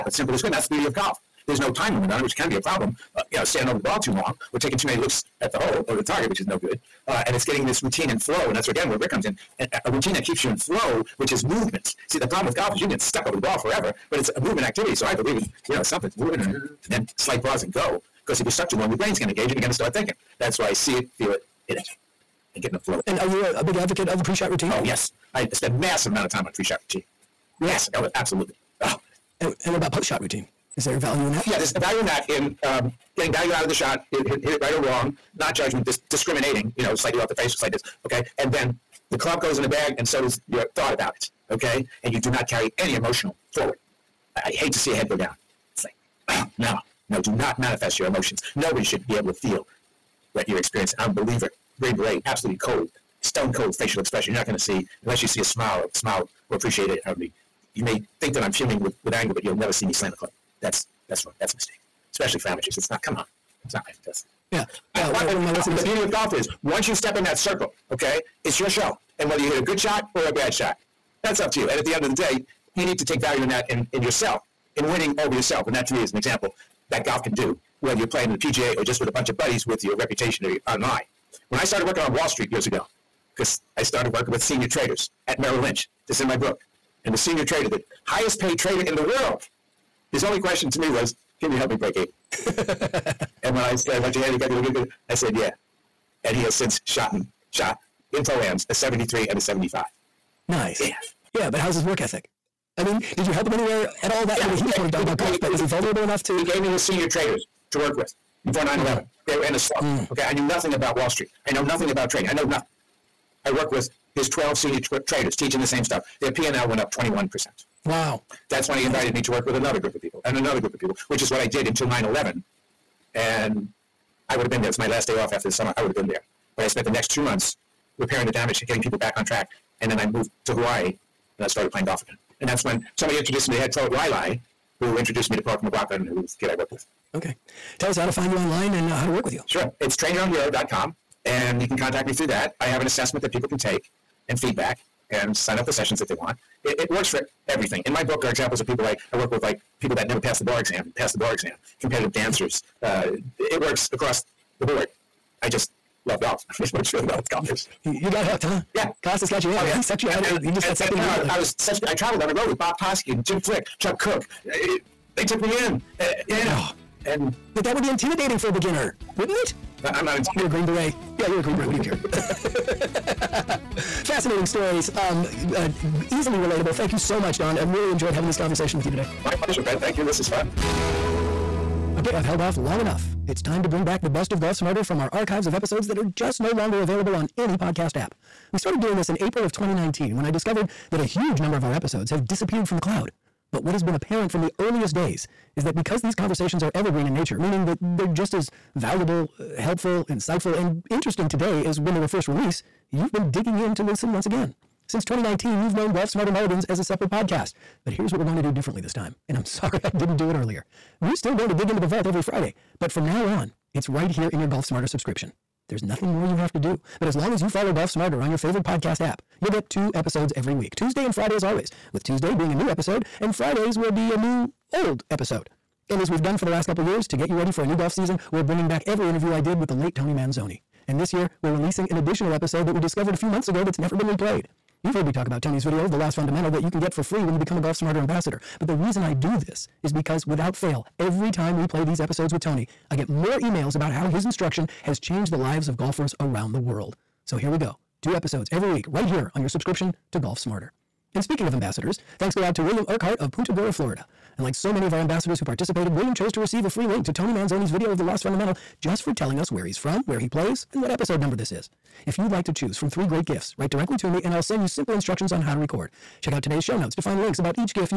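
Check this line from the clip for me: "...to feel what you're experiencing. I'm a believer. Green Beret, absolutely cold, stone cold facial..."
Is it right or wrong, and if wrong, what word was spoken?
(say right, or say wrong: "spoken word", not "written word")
right.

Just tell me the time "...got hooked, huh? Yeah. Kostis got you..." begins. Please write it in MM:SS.
02:38.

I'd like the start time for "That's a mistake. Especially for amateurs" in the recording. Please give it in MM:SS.
01:01.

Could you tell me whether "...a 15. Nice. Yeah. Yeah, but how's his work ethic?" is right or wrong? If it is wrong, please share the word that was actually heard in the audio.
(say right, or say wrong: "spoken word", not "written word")
wrong: "75", not "15".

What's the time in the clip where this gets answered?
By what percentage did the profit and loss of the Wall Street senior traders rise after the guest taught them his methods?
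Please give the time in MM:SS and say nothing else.
01:56.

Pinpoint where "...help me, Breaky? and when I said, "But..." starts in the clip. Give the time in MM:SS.
01:31.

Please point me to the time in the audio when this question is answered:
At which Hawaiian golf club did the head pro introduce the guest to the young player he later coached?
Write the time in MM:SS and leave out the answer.
02:13.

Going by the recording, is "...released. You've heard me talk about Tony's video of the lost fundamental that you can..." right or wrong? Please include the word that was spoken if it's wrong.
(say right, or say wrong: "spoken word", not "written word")
wrong: "replayed", not "released".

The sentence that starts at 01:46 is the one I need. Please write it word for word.
He gave me his senior traders to work with before 9 11.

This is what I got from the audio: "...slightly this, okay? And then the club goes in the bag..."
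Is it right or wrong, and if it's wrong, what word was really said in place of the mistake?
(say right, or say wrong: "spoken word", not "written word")
right.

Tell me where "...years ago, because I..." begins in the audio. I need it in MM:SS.
01:22.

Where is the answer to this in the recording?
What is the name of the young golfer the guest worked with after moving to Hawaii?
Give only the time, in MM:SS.
02:15.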